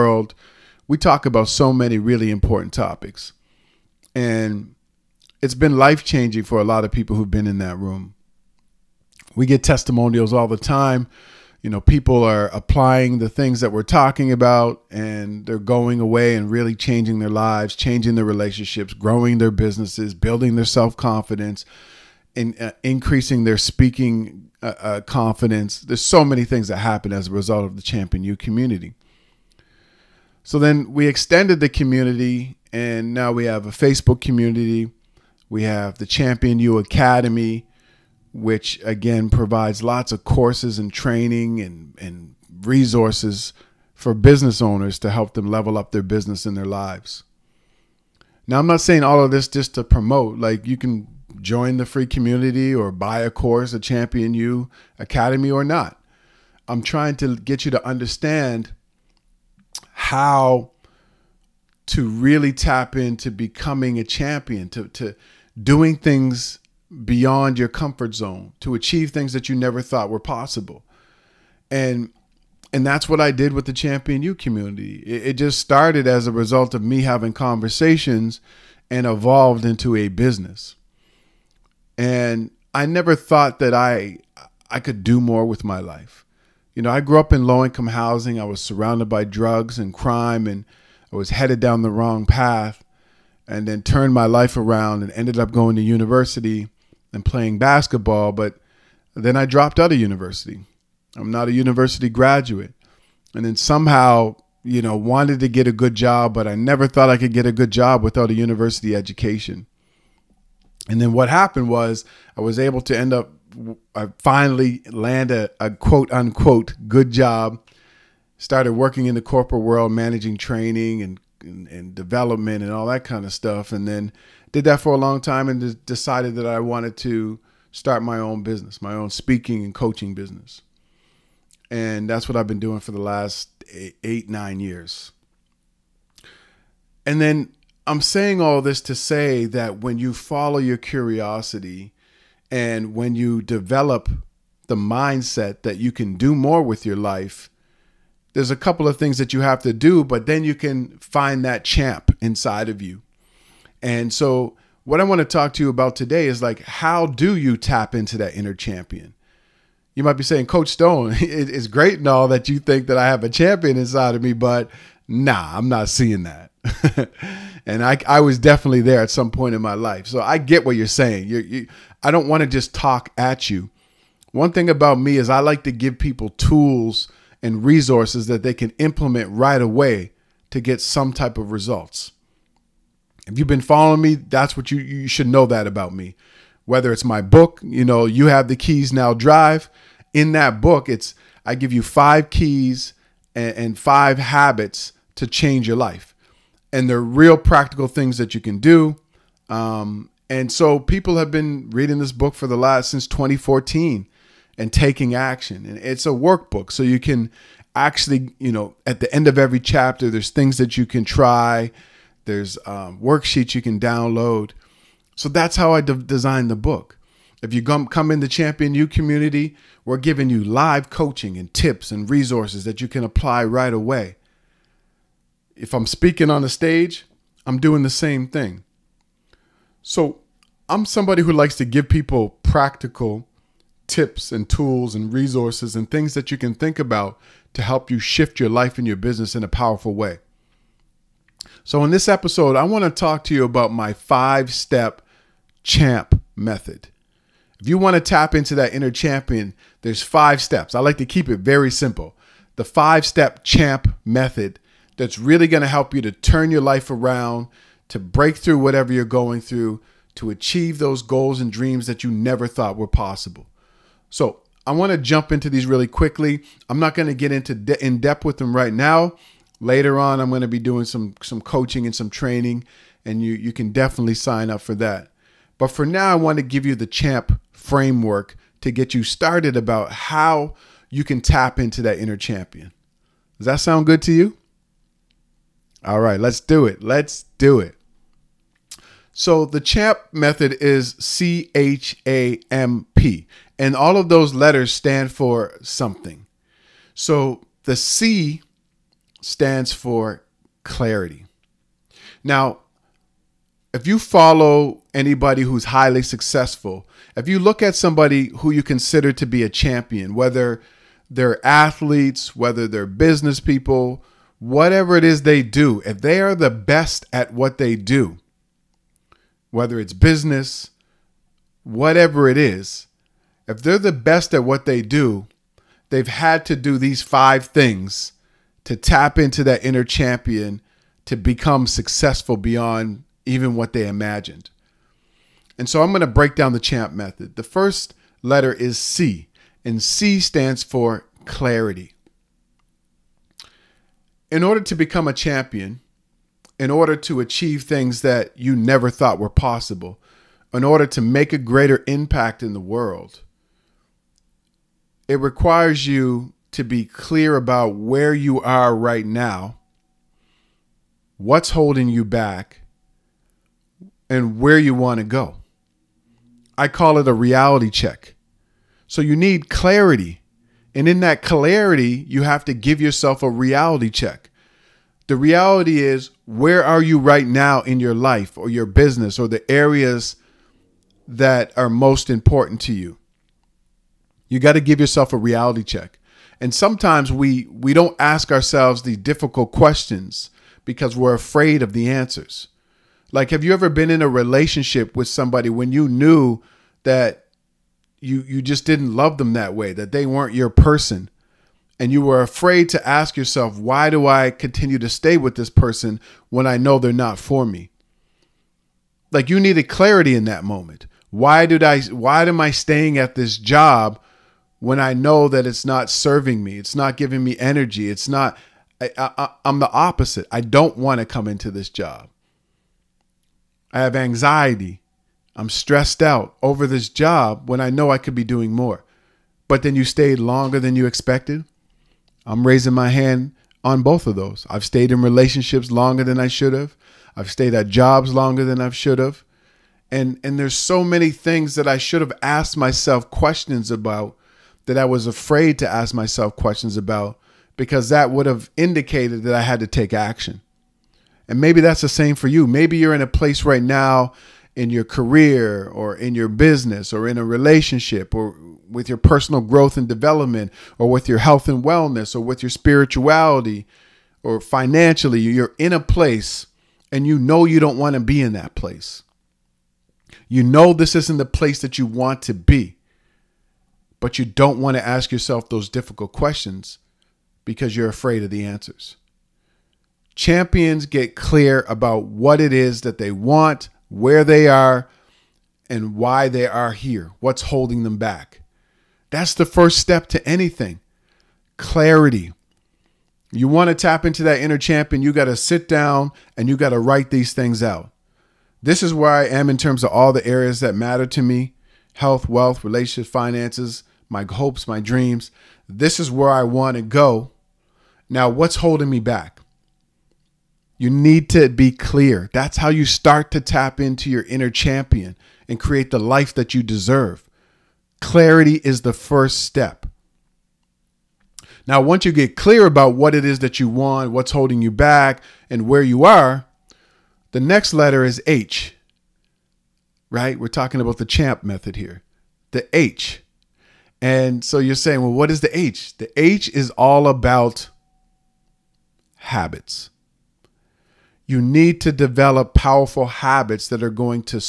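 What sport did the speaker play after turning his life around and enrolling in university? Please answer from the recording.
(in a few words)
basketball.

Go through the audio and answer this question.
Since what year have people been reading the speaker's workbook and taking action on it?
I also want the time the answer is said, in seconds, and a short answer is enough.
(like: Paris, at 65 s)
2014, at 203 s.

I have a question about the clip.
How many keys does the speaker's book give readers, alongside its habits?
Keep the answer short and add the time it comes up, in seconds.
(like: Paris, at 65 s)
5, at 191 s.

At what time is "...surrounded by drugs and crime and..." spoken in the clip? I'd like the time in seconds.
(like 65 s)
88 s.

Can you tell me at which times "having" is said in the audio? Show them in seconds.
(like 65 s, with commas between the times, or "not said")
77 s.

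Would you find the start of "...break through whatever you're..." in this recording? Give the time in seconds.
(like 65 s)
257 s.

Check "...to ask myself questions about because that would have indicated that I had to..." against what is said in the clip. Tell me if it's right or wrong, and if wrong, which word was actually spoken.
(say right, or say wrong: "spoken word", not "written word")
right.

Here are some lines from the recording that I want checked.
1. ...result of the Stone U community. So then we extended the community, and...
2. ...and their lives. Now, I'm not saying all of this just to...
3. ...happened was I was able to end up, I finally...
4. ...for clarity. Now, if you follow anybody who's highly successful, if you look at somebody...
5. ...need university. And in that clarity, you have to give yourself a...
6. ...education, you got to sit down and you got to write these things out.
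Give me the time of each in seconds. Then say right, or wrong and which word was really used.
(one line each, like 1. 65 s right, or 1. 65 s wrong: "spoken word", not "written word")
1. 27 s wrong: "Champion", not "Stone"
2. 46 s right
3. 111 s right
4. 299 s right
5. 369 s wrong: "clarity", not "university"
6. 494 s wrong: "champion", not "education".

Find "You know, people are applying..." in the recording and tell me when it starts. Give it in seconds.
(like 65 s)
11 s.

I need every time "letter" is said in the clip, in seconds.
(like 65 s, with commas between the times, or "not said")
294 s, 338 s, 527 s.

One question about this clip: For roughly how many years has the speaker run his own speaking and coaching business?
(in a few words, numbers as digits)
8 or 9 years.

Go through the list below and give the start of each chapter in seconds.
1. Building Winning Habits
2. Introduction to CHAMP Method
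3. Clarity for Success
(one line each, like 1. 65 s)
1. 518 s
2. 239 s
3. 337 s.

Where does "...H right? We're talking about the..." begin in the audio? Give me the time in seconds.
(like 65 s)
528 s.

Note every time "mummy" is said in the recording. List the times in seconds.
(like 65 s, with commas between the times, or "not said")
not said.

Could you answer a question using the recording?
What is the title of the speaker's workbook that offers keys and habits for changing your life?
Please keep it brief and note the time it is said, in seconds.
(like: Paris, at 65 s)
You Have the Keys Now Drive, at 188 s.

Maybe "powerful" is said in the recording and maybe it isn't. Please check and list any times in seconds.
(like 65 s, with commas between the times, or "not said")
239 s, 542 s.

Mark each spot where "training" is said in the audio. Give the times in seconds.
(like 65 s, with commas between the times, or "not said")
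40 s, 120 s, 272 s.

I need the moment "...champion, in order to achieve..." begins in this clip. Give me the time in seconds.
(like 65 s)
345 s.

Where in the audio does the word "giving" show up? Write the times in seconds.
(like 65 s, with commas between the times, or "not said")
219 s, 416 s.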